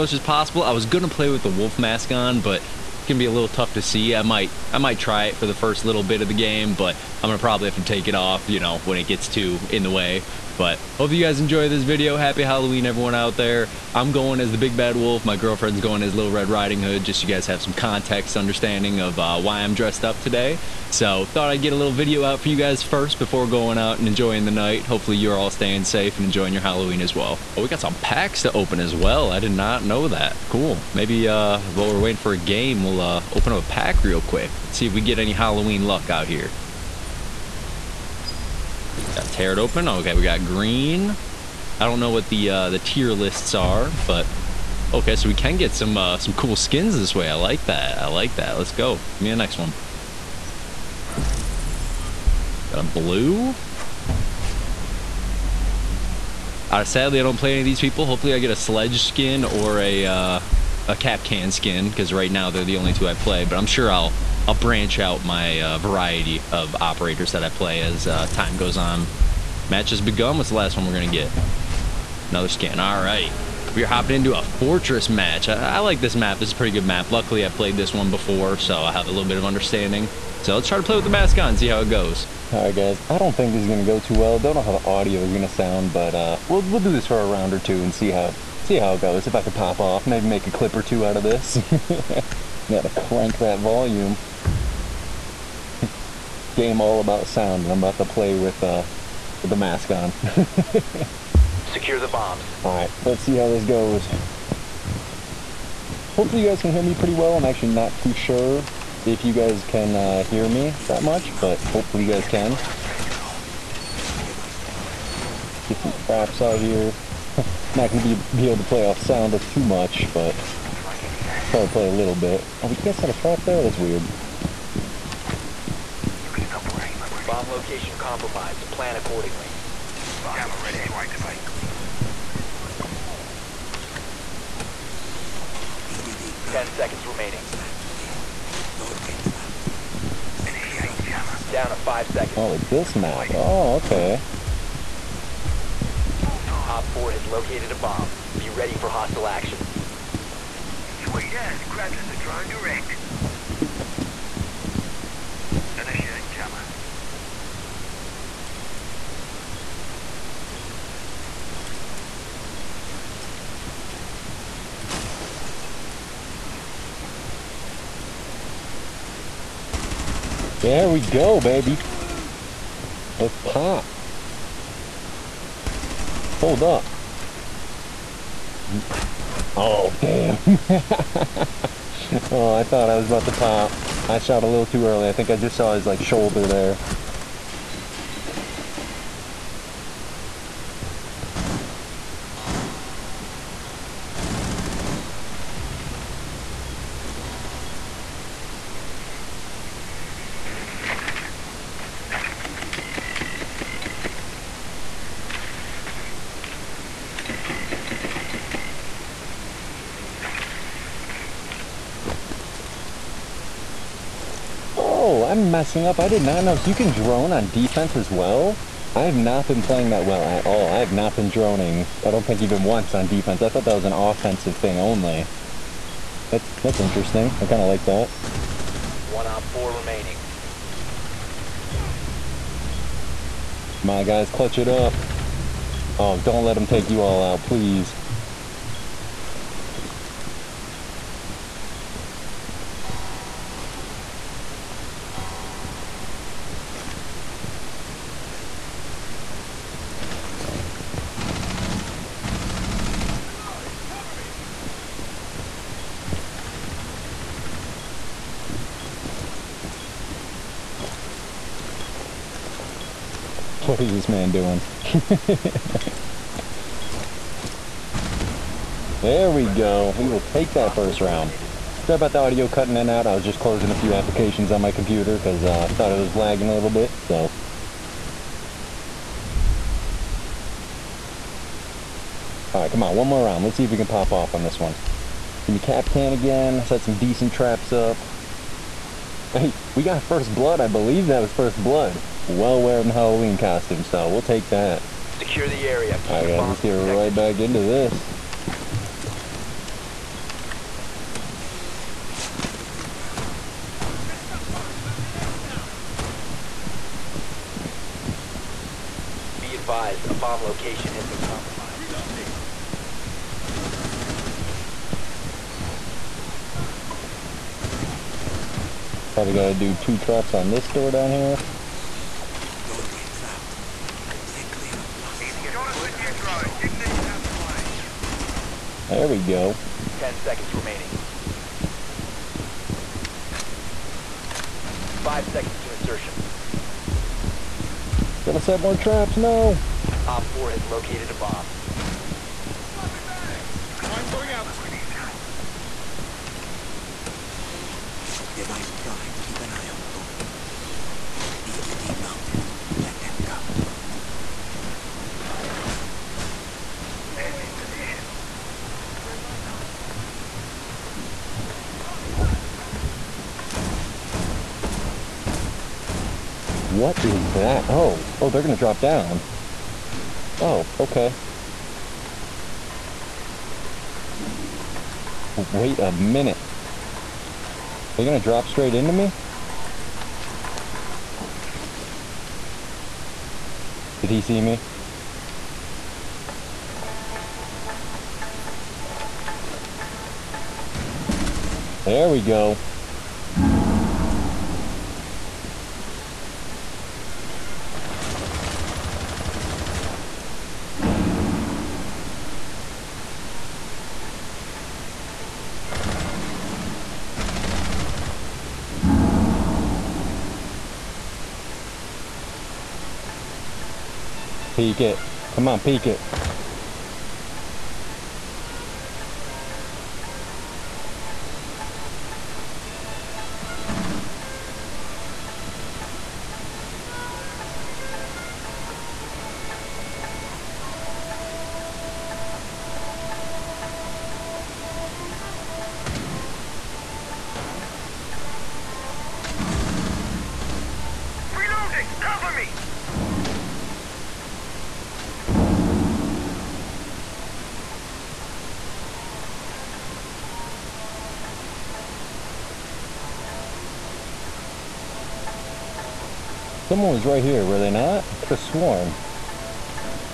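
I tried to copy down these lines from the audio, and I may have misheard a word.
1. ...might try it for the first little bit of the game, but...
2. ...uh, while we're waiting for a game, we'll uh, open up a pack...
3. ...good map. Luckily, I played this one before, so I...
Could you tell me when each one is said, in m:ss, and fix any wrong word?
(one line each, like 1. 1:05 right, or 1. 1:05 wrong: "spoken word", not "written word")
1. 0:04 right
2. 0:31 right
3. 1:16 right.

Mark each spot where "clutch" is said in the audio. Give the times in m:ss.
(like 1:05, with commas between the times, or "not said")
3:54.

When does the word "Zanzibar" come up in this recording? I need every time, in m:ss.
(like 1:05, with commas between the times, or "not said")
not said.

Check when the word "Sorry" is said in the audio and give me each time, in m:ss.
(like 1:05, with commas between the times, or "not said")
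4:31.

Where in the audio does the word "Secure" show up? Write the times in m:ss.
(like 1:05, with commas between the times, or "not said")
1:41, 4:55.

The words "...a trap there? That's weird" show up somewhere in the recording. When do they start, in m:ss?
2:03.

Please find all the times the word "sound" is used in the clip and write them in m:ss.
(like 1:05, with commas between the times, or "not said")
1:25, 1:37, 1:58.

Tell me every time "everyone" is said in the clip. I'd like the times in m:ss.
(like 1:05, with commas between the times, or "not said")
0:12.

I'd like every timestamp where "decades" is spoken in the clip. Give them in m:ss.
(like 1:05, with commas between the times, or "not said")
not said.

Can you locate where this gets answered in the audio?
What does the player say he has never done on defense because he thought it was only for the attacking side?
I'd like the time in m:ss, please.
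3:41.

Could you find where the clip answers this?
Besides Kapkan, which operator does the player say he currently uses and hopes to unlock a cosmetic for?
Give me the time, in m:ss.
0:58.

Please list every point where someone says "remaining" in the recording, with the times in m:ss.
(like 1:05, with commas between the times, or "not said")
2:17, 3:49, 5:30.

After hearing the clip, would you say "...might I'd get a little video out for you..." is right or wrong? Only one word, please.
wrong.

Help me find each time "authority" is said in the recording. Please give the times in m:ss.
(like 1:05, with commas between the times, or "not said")
not said.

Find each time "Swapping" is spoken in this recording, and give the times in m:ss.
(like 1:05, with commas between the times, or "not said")
5:42.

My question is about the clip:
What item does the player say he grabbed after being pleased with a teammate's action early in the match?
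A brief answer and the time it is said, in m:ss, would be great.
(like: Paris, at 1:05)
a drone, at 2:32.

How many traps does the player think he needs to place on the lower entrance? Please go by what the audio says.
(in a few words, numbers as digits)
2.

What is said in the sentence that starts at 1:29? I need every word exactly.
If I could pop off, maybe make a clip or two out of this.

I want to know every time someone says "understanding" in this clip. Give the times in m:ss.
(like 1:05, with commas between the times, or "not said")
0:18, 1:19.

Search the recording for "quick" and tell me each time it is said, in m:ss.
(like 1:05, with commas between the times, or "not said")
0:34.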